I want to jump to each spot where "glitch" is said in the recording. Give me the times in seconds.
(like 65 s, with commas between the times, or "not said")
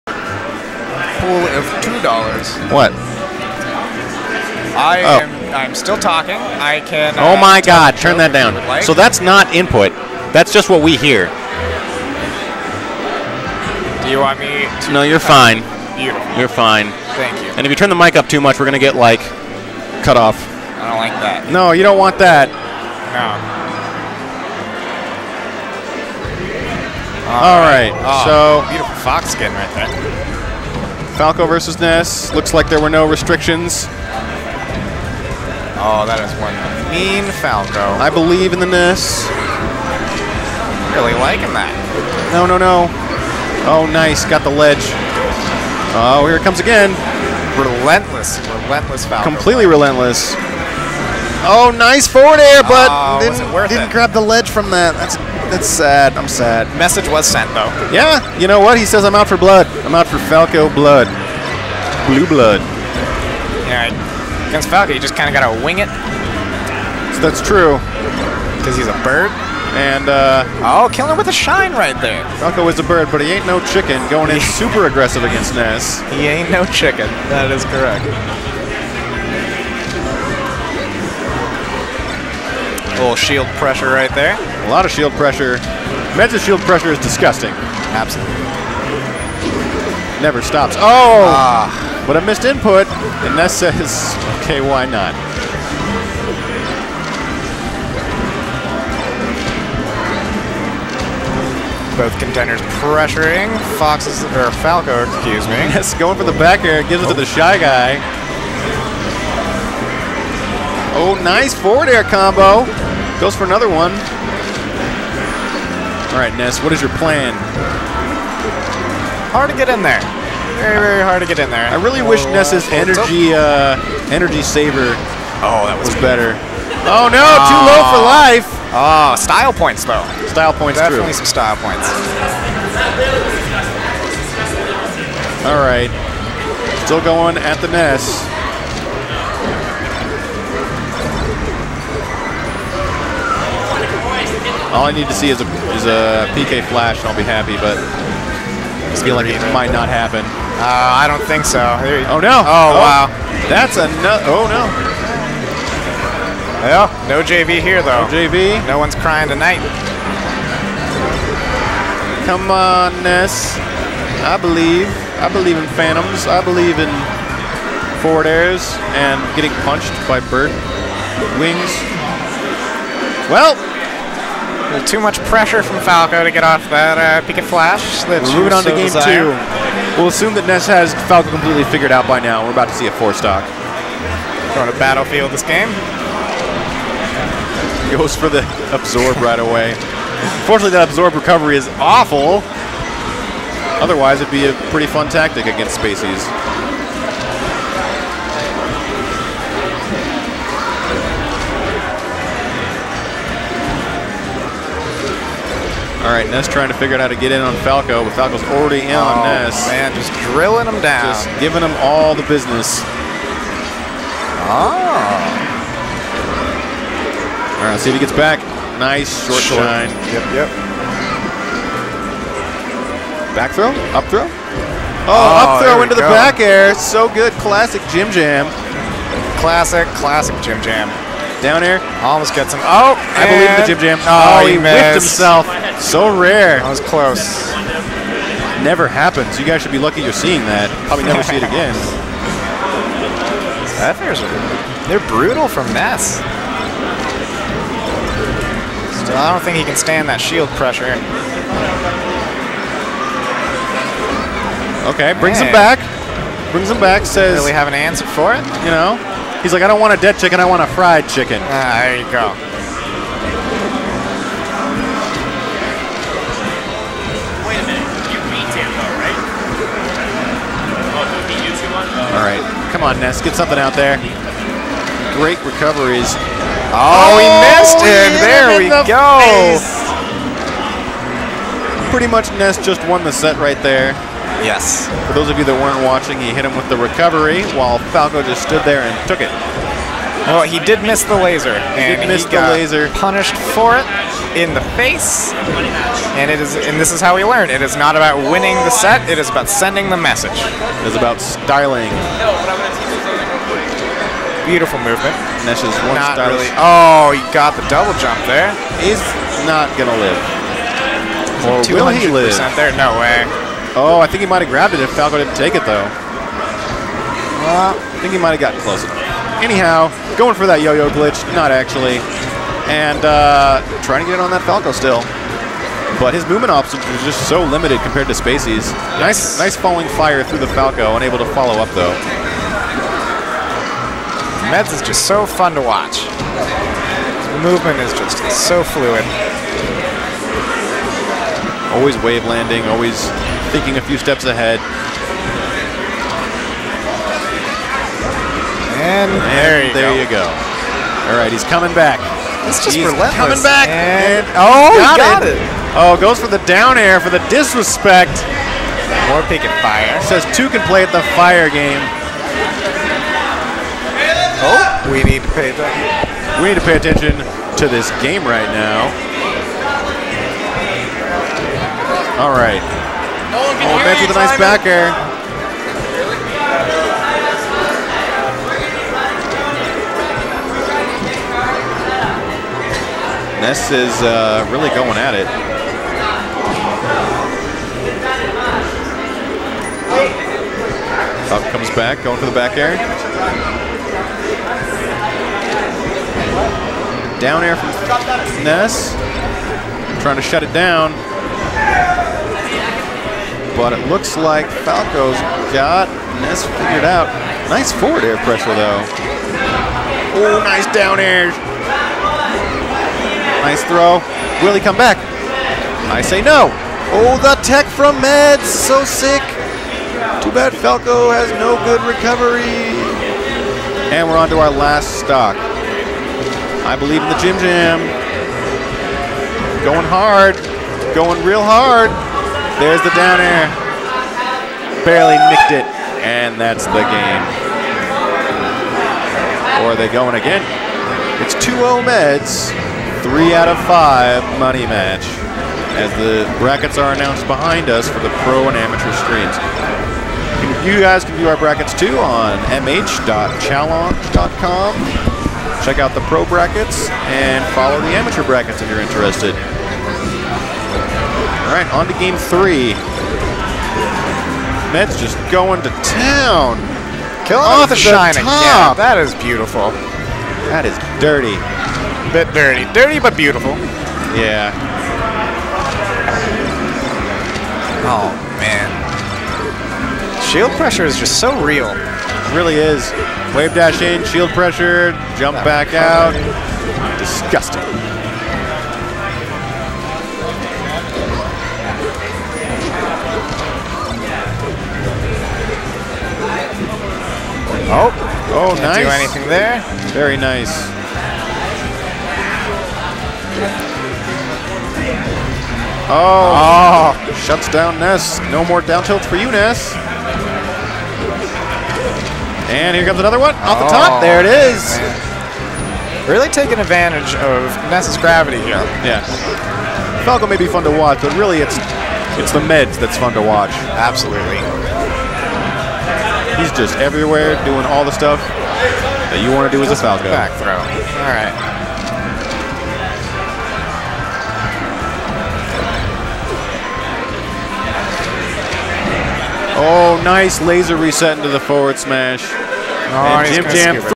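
320 s.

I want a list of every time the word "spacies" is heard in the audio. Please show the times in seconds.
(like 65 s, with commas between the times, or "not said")
195 s, 328 s.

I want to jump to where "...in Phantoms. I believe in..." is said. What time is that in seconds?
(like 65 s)
165 s.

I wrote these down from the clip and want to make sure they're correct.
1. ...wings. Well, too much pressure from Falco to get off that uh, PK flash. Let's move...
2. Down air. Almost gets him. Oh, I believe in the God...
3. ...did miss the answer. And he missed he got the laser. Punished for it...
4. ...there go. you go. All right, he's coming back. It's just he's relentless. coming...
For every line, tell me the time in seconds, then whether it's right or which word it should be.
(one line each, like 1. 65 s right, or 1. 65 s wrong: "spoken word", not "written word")
1. 171 s right
2. 231 s wrong: "Jim", not "God"
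3. 290 s wrong: "laser", not "answer"
4. 349 s right.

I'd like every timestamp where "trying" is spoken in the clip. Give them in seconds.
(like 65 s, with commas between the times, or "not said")
206 s, 323 s, 400 s.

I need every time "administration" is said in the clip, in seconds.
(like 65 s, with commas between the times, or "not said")
not said.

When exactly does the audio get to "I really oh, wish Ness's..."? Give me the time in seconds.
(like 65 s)
121 s.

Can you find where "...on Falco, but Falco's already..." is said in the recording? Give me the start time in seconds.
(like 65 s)
207 s.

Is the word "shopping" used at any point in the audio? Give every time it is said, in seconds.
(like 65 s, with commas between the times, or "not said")
not said.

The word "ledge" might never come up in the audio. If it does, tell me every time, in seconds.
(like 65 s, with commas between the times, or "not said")
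44 s, 54 s.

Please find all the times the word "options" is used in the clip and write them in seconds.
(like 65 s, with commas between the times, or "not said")
326 s.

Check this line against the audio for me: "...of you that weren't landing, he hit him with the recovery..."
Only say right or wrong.
wrong.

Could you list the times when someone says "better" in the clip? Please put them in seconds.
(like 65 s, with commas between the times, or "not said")
126 s.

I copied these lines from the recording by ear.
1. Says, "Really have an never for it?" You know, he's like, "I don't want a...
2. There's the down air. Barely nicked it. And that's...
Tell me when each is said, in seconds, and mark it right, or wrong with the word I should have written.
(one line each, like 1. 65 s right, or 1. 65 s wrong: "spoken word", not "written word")
1. 257 s wrong: "answer", not "never"
2. 432 s right.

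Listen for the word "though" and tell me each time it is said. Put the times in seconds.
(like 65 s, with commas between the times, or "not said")
57 s, 129 s, 157 s, 315 s, 331 s, 408 s.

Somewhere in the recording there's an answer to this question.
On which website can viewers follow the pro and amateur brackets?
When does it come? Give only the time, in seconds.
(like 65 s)
452 s.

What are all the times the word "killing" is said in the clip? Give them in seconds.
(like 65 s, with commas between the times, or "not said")
70 s, 467 s.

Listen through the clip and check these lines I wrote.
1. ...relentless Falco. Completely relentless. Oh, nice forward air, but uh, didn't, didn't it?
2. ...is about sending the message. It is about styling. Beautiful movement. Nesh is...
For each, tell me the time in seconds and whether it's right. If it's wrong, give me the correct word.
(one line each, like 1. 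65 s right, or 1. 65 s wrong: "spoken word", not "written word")
1. 48 s right
2. 299 s right.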